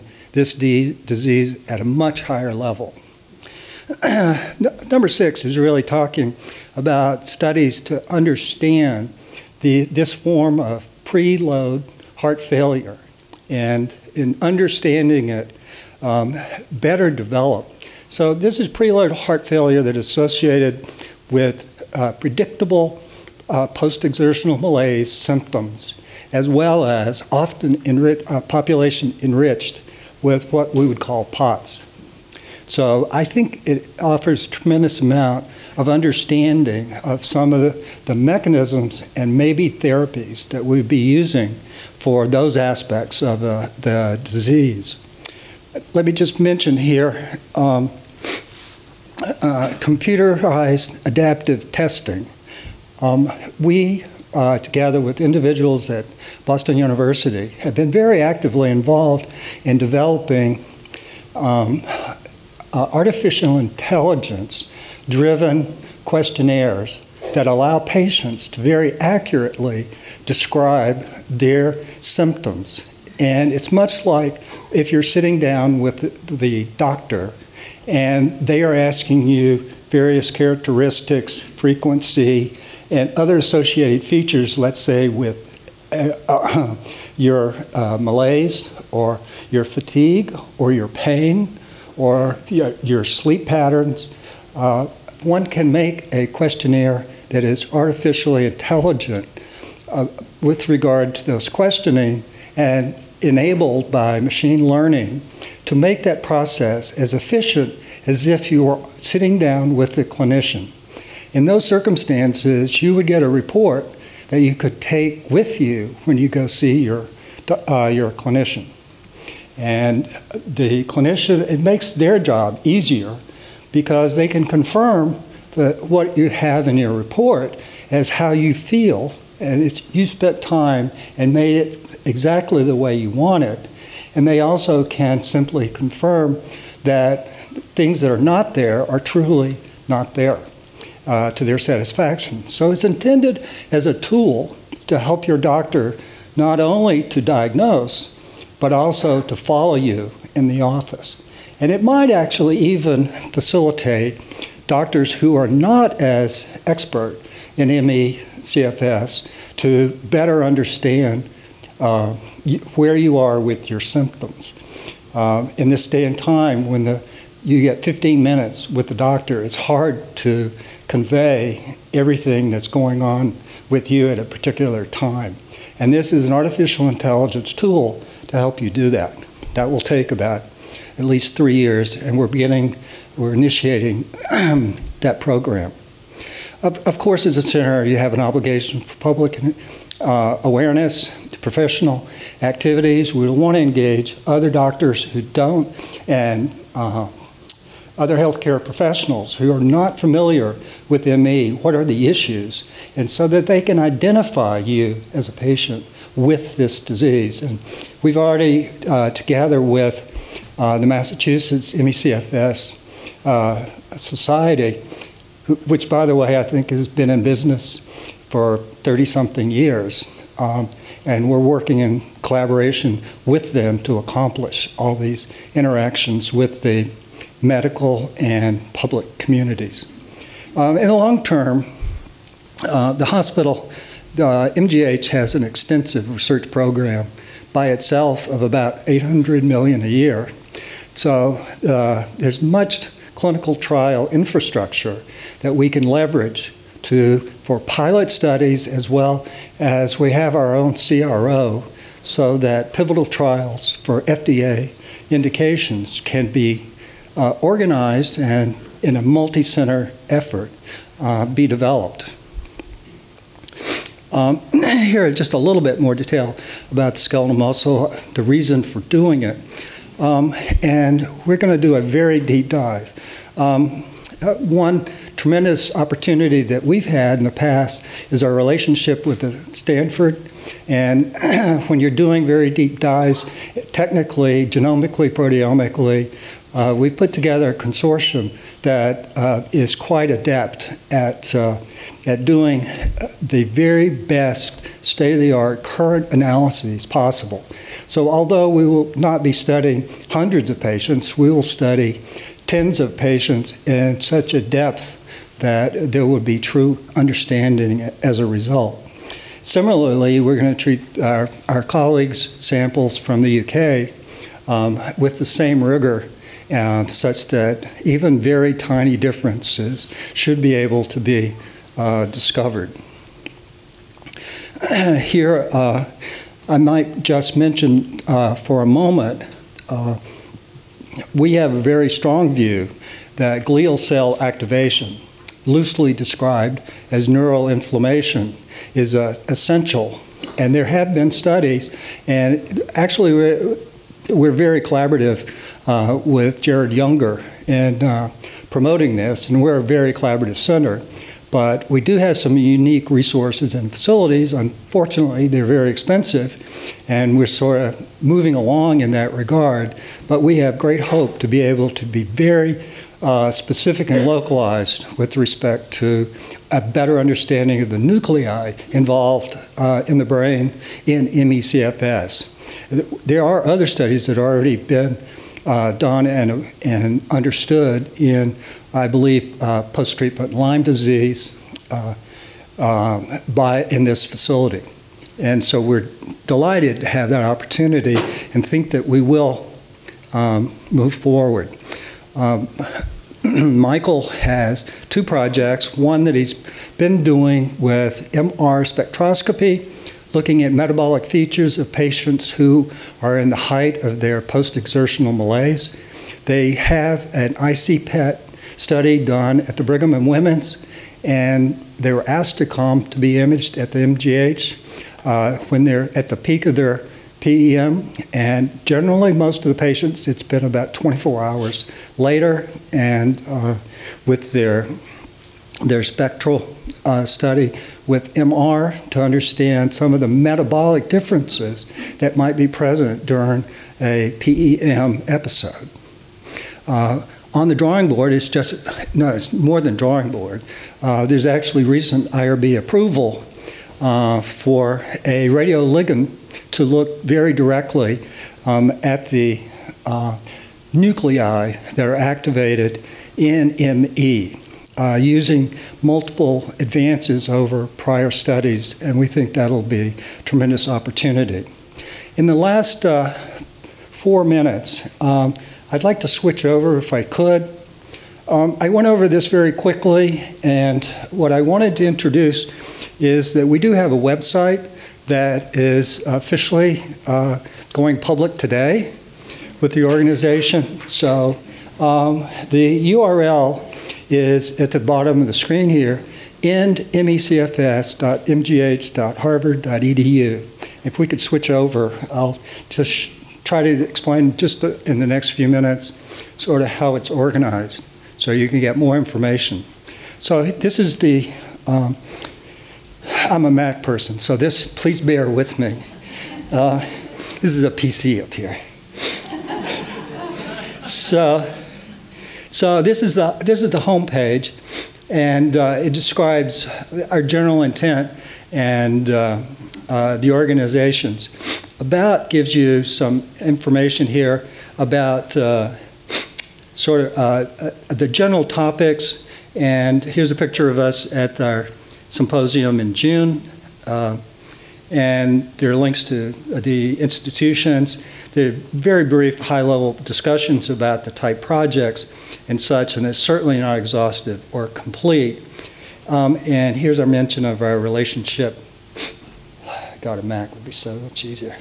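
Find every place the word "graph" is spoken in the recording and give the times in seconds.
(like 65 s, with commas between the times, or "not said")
not said.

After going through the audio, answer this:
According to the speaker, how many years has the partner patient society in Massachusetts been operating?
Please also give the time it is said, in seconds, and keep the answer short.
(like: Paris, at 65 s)
30 something years, at 218 s.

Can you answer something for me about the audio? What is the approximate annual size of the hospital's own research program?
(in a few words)
800 million.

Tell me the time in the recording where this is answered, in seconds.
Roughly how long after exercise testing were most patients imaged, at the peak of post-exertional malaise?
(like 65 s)
420 s.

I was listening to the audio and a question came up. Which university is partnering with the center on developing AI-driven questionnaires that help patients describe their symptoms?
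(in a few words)
Boston University.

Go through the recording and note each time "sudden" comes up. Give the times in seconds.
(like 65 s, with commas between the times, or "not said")
not said.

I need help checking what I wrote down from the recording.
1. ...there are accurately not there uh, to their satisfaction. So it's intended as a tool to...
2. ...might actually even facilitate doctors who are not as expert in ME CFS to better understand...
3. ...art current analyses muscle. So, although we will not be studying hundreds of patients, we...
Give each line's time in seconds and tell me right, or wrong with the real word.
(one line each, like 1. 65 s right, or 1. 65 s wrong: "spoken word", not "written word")
1. 138 s wrong: "truly", not "accurately"
2. 151 s right
3. 295 s wrong: "possible", not "muscle".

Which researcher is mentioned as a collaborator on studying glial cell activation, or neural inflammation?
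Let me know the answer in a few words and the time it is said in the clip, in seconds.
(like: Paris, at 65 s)
Jared Younger, at 346 s.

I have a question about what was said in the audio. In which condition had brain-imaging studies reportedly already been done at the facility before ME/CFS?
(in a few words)
post-treatment Lyme disease.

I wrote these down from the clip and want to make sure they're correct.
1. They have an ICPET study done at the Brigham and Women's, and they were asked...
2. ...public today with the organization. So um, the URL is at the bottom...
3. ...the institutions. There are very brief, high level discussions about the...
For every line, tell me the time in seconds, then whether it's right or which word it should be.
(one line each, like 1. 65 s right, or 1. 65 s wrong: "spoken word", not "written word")
1. 406 s right
2. 477 s right
3. 536 s right.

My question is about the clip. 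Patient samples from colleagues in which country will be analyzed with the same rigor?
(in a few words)
UK.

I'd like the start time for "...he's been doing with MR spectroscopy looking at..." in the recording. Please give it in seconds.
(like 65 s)
396 s.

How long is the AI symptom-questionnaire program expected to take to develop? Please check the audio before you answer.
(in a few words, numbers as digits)
at least 3 years.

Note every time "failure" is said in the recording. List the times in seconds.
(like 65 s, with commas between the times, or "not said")
12 s, 19 s.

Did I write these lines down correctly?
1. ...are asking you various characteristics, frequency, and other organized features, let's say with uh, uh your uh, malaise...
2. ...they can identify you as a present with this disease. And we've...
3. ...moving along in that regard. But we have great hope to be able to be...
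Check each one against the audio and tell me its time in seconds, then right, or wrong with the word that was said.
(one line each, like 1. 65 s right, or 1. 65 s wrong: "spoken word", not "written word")
1. 78 s wrong: "associated", not "organized"
2. 203 s wrong: "patient", not "present"
3. 358 s right.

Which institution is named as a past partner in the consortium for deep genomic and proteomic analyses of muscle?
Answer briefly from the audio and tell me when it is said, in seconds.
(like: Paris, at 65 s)
Stanford, at 279 s.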